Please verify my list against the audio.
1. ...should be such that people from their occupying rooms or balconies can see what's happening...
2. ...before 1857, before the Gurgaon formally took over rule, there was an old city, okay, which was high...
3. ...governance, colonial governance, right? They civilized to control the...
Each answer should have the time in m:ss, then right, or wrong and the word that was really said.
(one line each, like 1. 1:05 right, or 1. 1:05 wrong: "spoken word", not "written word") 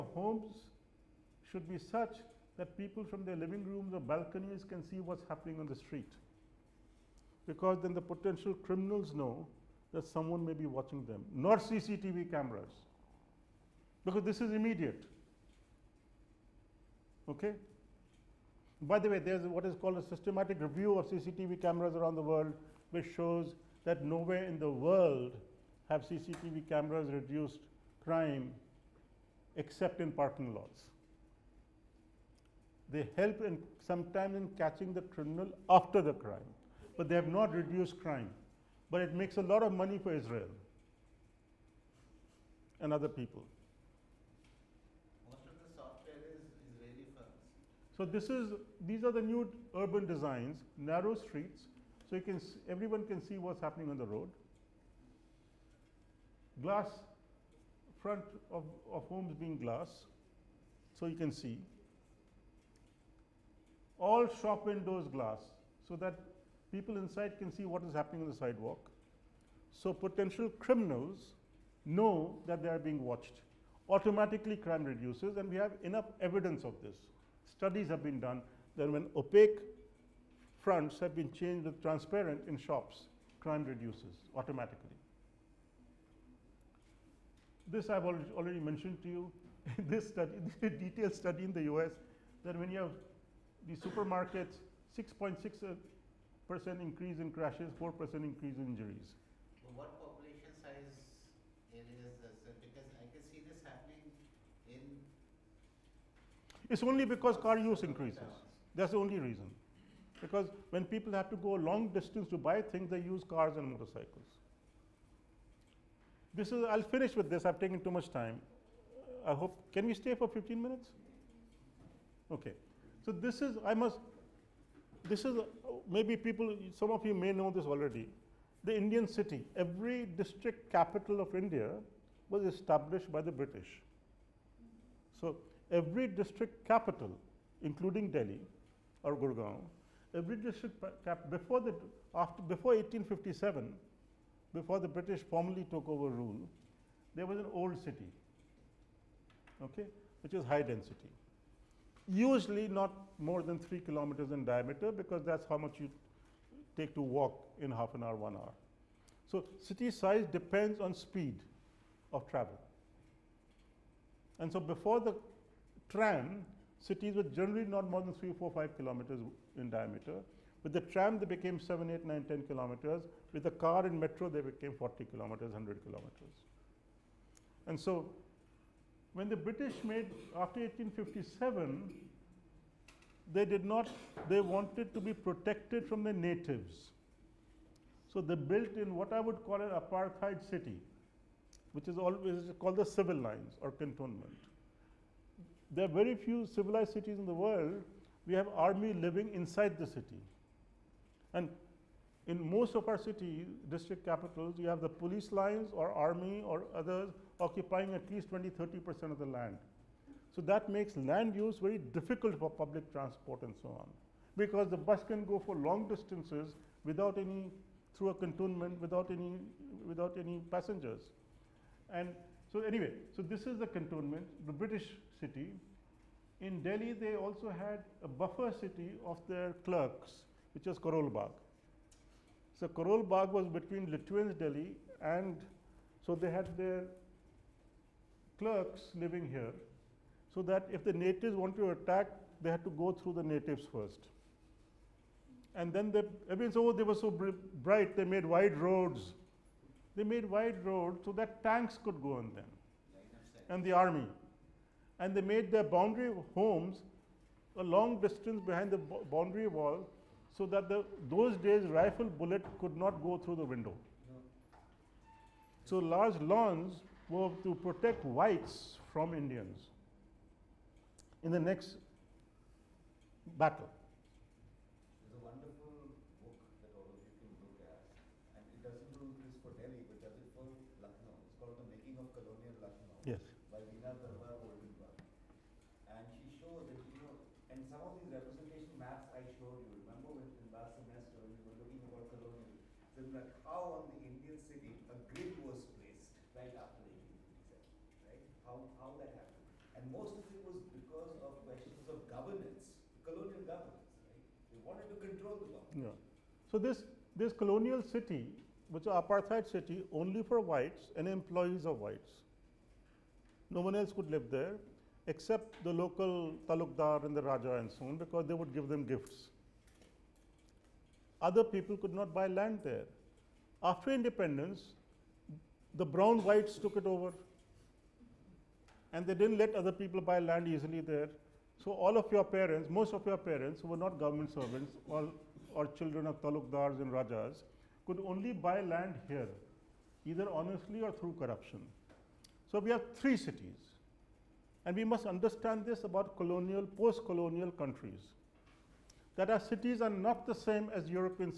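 1. 0:01 wrong: "living", not "occupying"
2. 2:22 wrong: "British", not "Gurgaon"
3. 5:02 wrong: "wanted", not "civilized".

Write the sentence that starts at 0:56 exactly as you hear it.
Glass front of, of homes being glass, so you can see.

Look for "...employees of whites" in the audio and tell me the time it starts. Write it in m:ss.
5:11.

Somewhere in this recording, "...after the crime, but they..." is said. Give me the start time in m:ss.
0:35.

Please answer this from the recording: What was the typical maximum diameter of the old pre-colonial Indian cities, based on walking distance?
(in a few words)
3 kilometers.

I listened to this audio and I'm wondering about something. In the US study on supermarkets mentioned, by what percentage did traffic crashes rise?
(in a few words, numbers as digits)
6.6 percent.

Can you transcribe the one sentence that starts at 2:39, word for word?
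So city size depends on speed of travel.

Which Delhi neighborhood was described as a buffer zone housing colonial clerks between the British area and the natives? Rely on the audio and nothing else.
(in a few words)
Karol Bagh.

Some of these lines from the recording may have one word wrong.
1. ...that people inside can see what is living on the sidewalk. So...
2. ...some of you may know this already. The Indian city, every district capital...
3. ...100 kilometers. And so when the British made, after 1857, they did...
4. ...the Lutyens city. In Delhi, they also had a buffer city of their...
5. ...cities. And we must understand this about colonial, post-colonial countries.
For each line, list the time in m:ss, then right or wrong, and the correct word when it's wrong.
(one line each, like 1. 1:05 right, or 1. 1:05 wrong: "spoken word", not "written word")
1. 1:05 wrong: "happening", not "living"
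2. 2:06 right
3. 2:55 right
4. 3:44 wrong: "British", not "Lutyens"
5. 5:43 right.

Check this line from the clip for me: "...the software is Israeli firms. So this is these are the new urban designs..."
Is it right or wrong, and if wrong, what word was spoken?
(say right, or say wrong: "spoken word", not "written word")
right.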